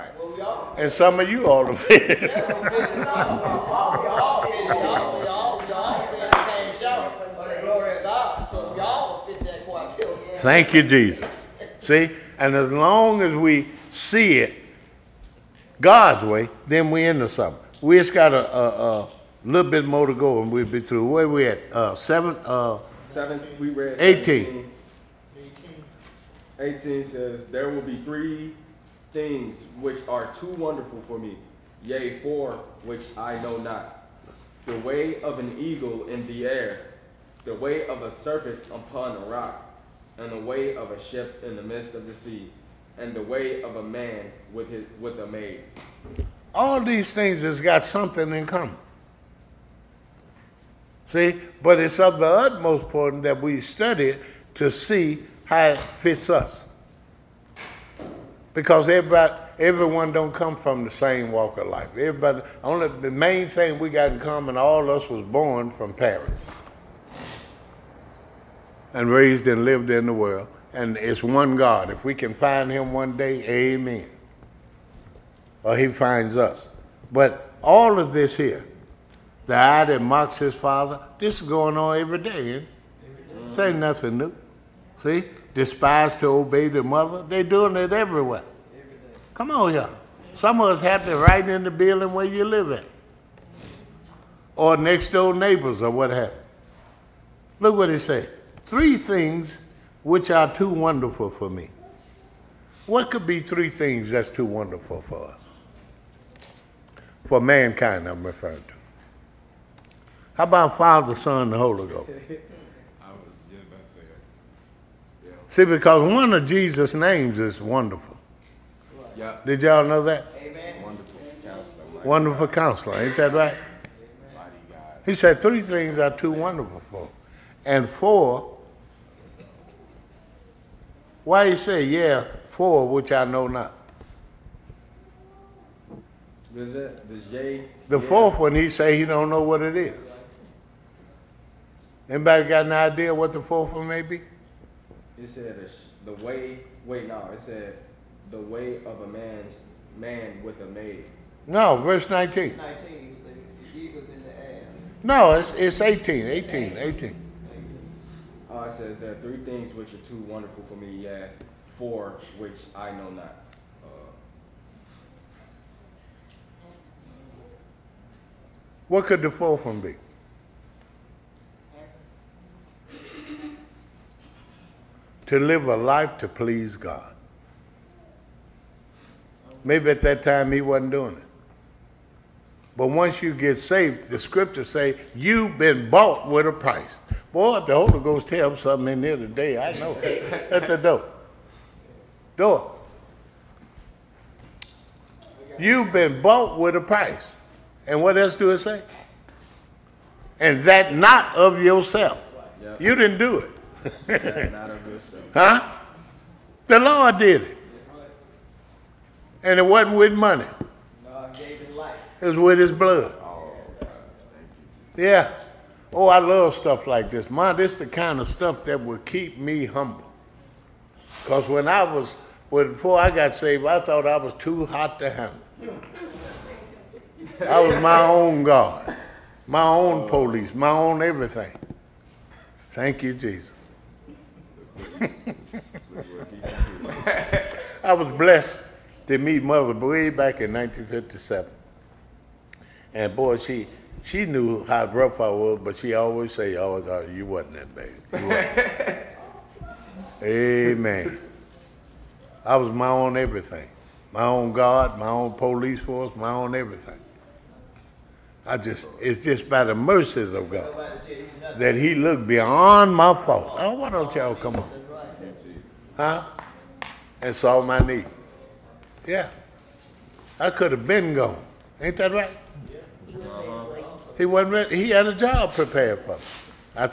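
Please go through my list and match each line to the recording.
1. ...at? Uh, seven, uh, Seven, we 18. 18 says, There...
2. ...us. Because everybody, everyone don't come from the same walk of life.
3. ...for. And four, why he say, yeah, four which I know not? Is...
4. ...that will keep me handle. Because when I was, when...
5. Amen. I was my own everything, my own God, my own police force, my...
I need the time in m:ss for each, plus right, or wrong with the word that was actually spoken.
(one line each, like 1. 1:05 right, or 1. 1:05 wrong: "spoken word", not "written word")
1. 0:21 right
2. 0:56 right
3. 2:06 right
4. 3:38 wrong: "humble", not "handle"
5. 4:10 right.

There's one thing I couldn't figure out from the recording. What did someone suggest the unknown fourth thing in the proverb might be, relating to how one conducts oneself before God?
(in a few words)
To live a life to please God.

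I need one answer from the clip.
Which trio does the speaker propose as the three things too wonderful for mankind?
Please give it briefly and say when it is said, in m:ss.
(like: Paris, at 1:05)
Father, Son, and the Holy Ghost, at 1:50.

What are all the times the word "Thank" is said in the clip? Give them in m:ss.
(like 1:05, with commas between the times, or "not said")
0:10, 3:52.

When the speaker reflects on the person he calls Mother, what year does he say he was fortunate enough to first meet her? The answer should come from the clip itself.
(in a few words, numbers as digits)
1957.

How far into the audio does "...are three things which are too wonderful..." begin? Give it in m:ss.
2:39.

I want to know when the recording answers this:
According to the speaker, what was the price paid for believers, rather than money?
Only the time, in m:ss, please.
3:32.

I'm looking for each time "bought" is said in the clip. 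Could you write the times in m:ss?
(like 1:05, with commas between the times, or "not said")
3:05, 3:16.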